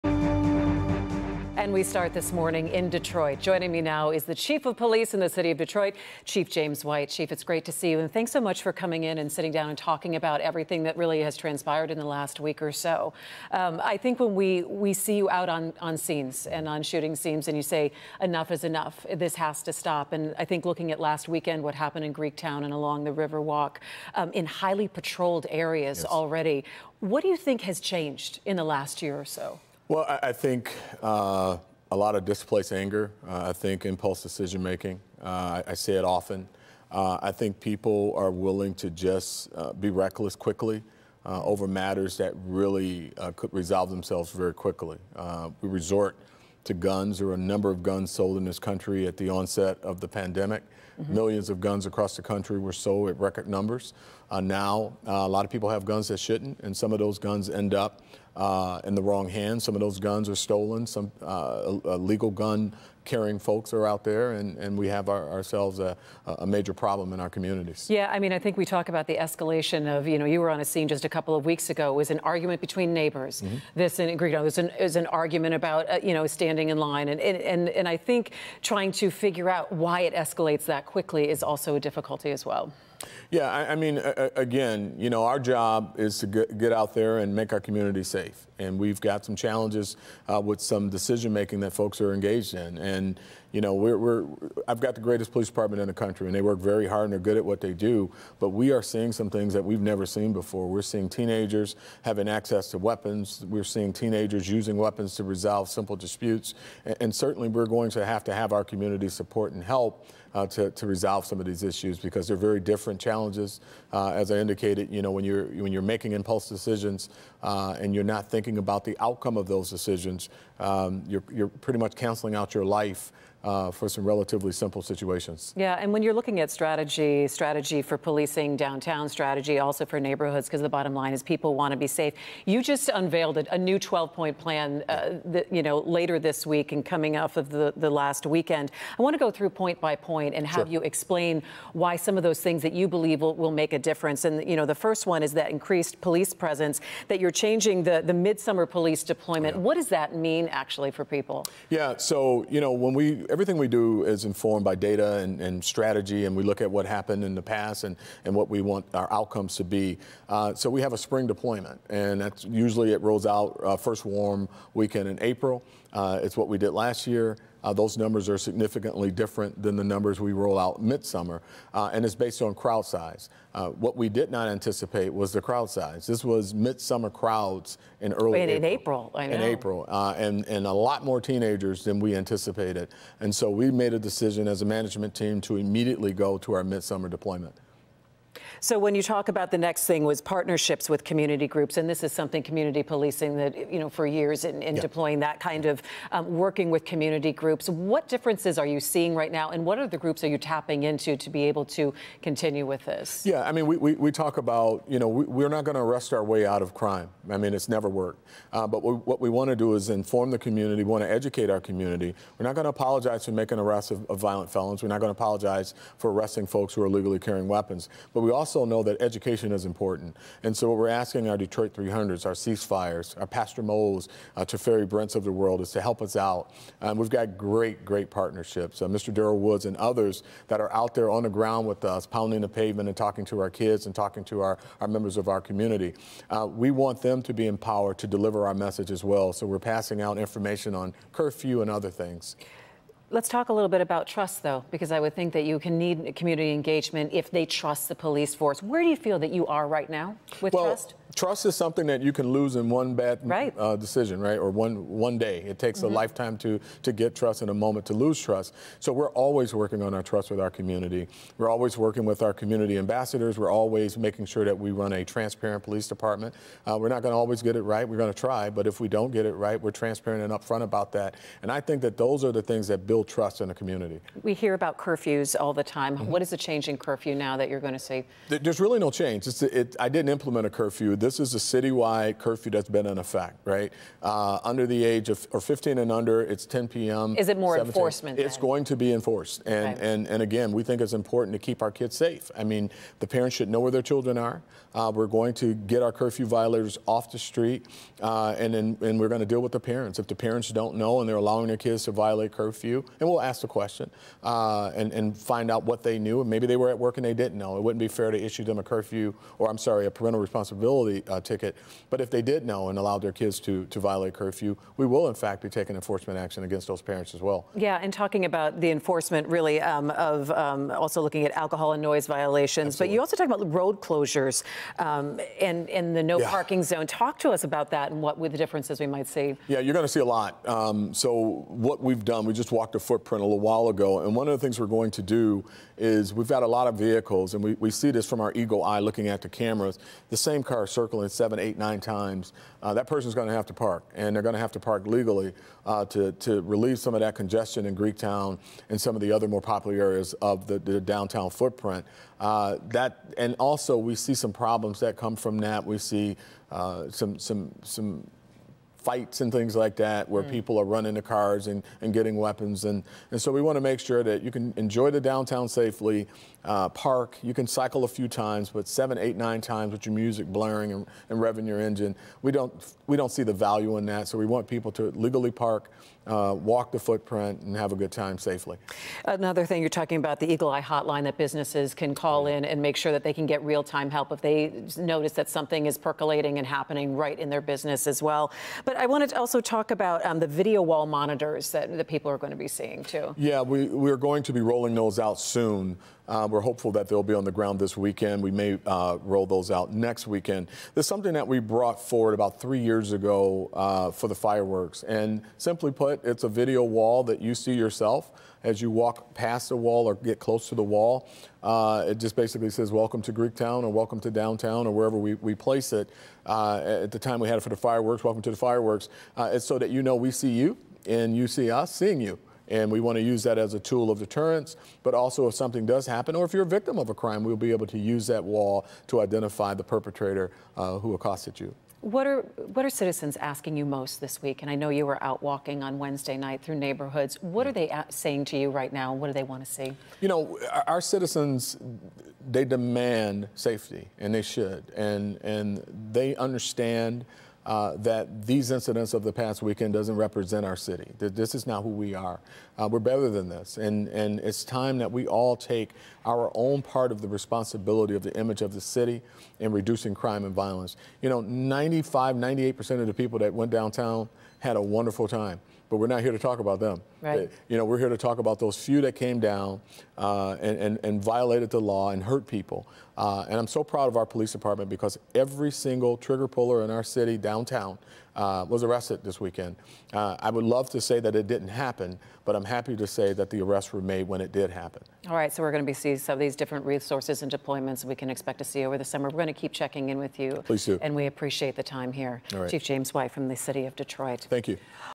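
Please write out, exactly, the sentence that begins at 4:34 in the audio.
We hear about curfews all the time.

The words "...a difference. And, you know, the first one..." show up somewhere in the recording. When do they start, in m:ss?
2:23.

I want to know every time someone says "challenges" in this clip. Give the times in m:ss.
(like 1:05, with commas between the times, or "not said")
1:29, 1:53.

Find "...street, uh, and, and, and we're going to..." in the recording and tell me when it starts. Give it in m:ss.
4:57.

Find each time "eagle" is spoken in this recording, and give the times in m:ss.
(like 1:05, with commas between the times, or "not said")
5:38, 6:20.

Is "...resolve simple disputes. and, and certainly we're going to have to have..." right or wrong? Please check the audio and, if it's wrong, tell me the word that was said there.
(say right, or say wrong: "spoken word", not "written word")
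right.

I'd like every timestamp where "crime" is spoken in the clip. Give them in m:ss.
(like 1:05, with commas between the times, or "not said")
3:26, 7:06, 7:39.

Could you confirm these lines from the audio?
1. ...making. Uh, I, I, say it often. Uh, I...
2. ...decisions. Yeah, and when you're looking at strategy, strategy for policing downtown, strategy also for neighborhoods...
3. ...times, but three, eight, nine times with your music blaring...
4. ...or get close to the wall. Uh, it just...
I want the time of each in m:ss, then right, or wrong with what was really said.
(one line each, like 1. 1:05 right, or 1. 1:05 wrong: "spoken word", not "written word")
1. 0:34 right
2. 2:04 wrong: "situations", not "decisions"
3. 6:08 wrong: "seven", not "three"
4. 6:49 right.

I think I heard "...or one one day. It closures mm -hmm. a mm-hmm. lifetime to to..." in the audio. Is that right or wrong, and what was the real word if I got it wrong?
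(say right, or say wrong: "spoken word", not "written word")
wrong: "takes", not "closures".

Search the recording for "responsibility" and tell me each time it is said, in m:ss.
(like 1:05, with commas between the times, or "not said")
5:10, 7:37.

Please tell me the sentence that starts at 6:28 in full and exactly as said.
But but I wanted to also talk about um, the video wall monitors that the people are going to be seeing too.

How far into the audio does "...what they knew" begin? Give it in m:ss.
5:05.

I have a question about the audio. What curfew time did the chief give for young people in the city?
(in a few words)
10 p.m.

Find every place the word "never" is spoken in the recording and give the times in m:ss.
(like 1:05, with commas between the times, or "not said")
1:39, 3:27.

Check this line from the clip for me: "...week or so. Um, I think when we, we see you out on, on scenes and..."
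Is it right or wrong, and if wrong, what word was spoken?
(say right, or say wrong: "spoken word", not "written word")
right.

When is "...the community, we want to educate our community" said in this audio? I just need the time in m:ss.
3:30.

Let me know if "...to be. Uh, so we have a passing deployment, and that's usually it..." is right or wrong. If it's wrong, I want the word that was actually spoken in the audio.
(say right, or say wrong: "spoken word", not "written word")
wrong: "spring", not "passing".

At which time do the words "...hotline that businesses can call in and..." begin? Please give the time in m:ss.
6:20.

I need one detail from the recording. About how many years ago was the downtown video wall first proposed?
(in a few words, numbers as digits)
3 years.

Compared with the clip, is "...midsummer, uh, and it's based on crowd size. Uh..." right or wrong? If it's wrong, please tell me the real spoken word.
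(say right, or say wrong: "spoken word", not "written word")
right.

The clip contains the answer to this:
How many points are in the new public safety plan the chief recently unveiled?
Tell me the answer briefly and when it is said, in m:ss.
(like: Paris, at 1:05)
12, at 2:13.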